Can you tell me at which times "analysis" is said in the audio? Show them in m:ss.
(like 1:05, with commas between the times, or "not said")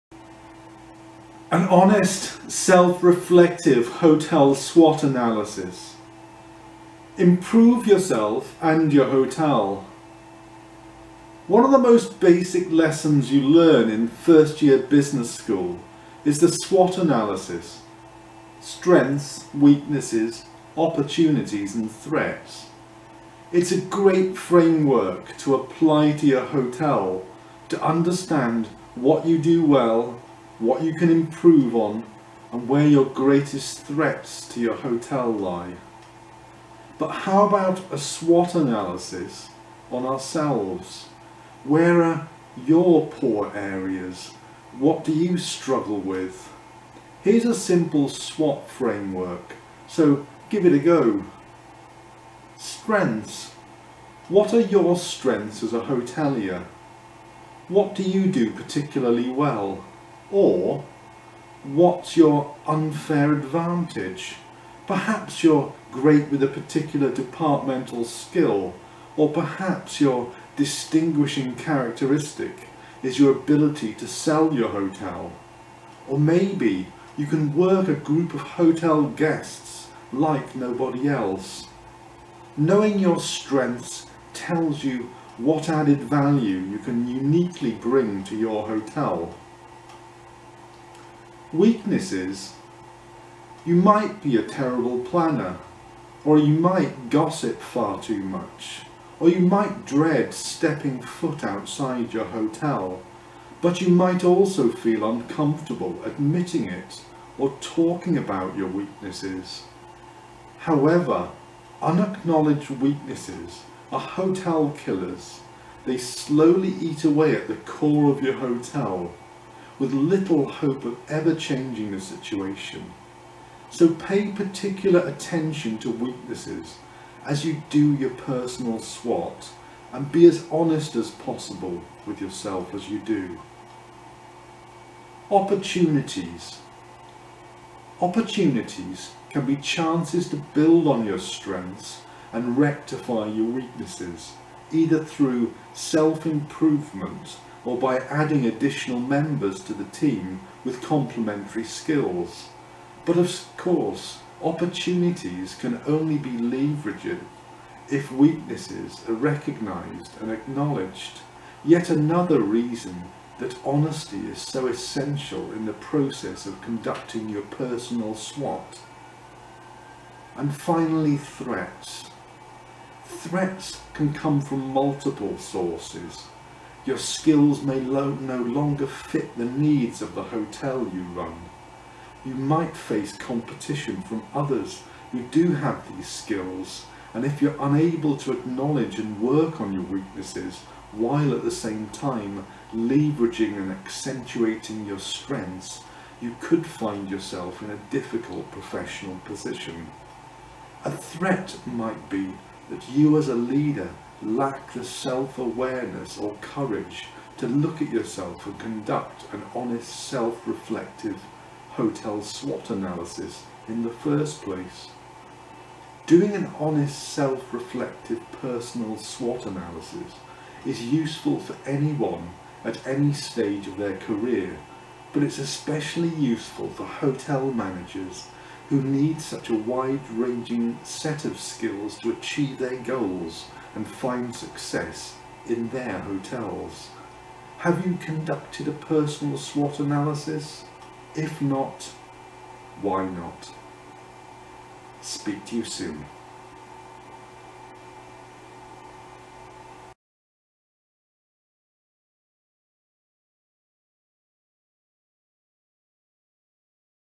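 0:05, 0:16, 0:38, 3:32, 3:39, 3:59.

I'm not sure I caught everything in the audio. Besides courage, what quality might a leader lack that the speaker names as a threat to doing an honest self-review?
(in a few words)
Self-awareness.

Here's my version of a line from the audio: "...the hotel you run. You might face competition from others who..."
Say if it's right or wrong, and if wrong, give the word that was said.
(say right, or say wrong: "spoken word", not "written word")
right.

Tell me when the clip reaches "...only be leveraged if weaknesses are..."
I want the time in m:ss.
2:35.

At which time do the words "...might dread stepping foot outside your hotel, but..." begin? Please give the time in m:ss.
1:39.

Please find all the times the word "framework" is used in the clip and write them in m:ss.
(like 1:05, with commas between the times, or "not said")
0:24, 0:48.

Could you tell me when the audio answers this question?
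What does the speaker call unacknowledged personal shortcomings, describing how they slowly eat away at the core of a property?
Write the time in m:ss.
1:53.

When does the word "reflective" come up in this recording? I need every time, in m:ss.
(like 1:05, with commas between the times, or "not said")
0:03, 3:30, 3:37.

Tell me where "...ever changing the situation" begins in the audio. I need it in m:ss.
2:01.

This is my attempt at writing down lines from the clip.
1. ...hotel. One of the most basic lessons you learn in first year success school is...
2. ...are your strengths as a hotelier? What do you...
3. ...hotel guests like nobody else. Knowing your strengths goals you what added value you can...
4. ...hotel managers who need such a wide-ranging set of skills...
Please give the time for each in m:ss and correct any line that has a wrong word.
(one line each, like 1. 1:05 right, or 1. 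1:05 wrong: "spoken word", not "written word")
1. 0:09 wrong: "business", not "success"
2. 0:54 right
3. 1:18 wrong: "tells", not "goals"
4. 3:46 right.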